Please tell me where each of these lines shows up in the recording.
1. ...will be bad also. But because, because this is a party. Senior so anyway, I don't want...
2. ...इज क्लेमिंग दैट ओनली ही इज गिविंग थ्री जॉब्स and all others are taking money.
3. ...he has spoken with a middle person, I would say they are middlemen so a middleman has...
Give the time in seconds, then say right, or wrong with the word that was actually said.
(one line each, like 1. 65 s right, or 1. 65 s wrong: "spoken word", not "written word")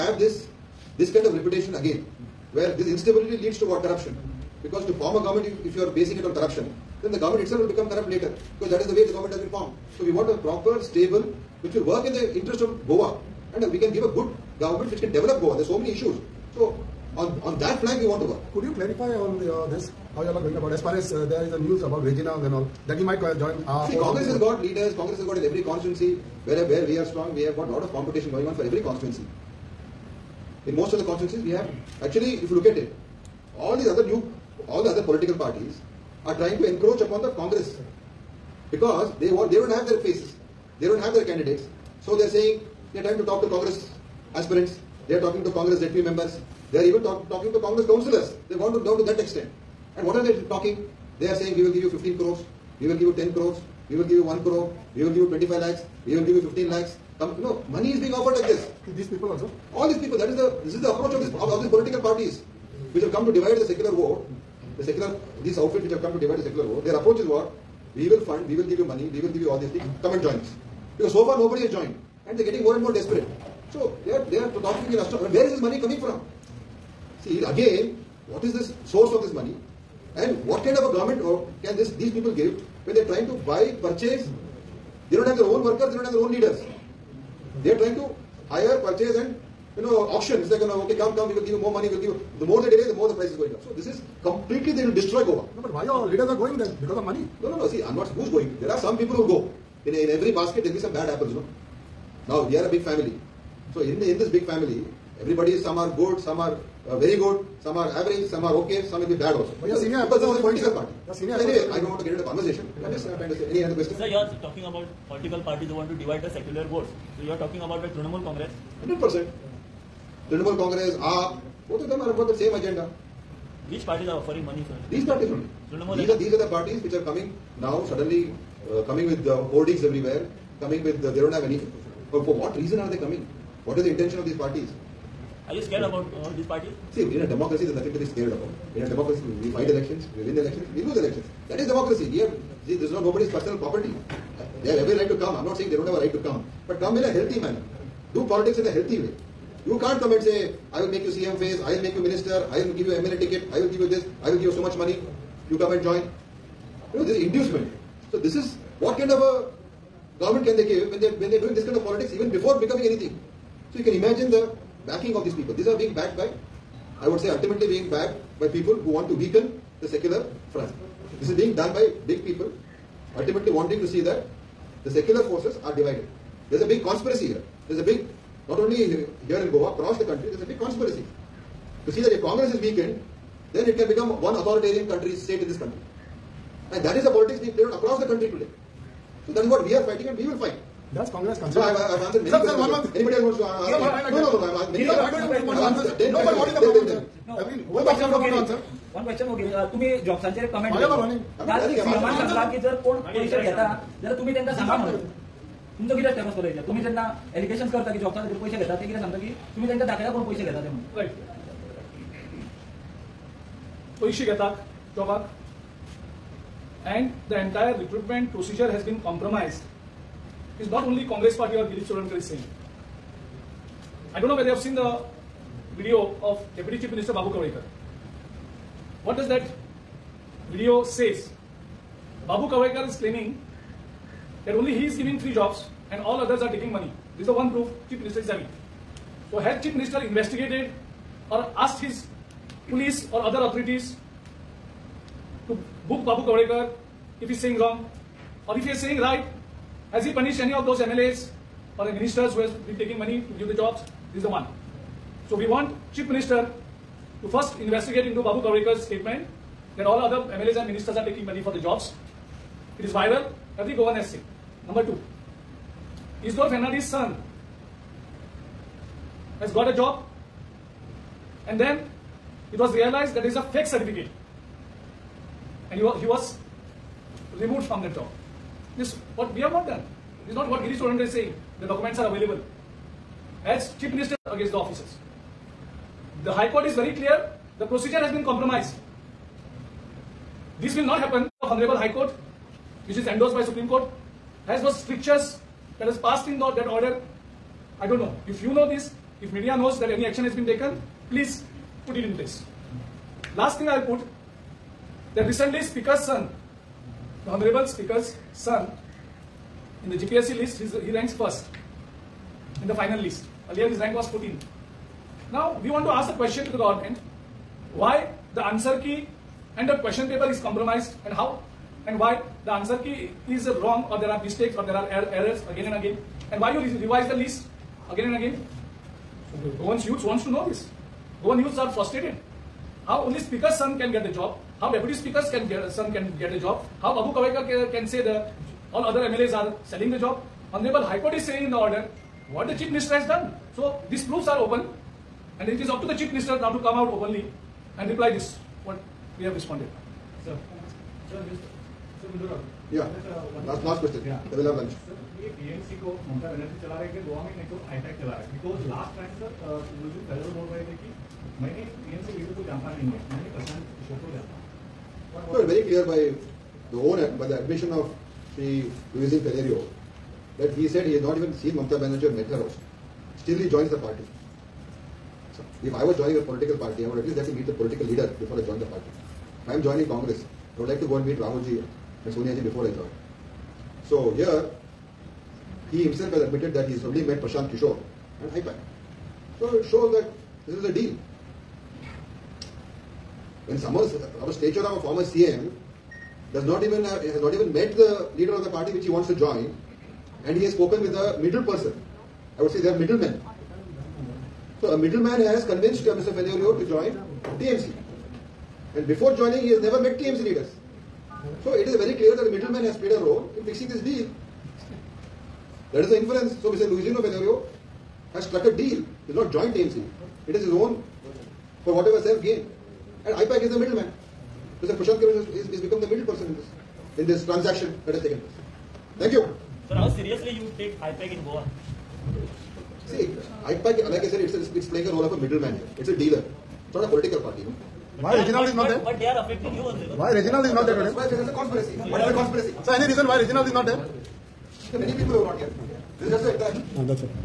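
1. 109 s right
2. 232 s right
3. 400 s right.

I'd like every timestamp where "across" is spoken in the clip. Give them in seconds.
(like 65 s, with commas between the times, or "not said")
179 s, 187 s.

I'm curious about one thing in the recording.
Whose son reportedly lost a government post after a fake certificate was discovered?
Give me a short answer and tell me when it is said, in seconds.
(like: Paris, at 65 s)
Isidore Fernandes, at 266 s.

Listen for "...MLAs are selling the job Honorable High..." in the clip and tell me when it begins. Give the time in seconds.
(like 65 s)
339 s.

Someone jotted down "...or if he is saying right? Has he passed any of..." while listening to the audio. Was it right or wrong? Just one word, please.
wrong.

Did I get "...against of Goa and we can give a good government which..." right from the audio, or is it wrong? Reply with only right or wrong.
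wrong.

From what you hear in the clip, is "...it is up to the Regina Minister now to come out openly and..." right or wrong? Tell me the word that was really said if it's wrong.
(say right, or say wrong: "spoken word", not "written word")
wrong: "Chief", not "Regina".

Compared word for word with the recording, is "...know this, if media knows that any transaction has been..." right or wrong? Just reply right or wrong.
wrong.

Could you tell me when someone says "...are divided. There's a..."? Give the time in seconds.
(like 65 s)
175 s.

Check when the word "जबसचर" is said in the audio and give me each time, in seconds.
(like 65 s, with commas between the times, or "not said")
200 s.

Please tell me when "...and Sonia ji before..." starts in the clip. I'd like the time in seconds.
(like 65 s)
382 s.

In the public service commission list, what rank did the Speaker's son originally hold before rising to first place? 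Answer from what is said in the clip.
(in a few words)
14.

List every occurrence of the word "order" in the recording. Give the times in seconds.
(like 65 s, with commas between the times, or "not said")
296 s, 341 s.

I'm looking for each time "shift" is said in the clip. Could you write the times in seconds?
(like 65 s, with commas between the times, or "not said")
not said.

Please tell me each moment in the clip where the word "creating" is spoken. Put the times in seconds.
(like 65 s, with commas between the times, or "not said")
not said.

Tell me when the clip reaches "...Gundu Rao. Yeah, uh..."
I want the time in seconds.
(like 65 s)
352 s.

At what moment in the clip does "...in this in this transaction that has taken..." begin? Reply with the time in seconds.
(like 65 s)
426 s.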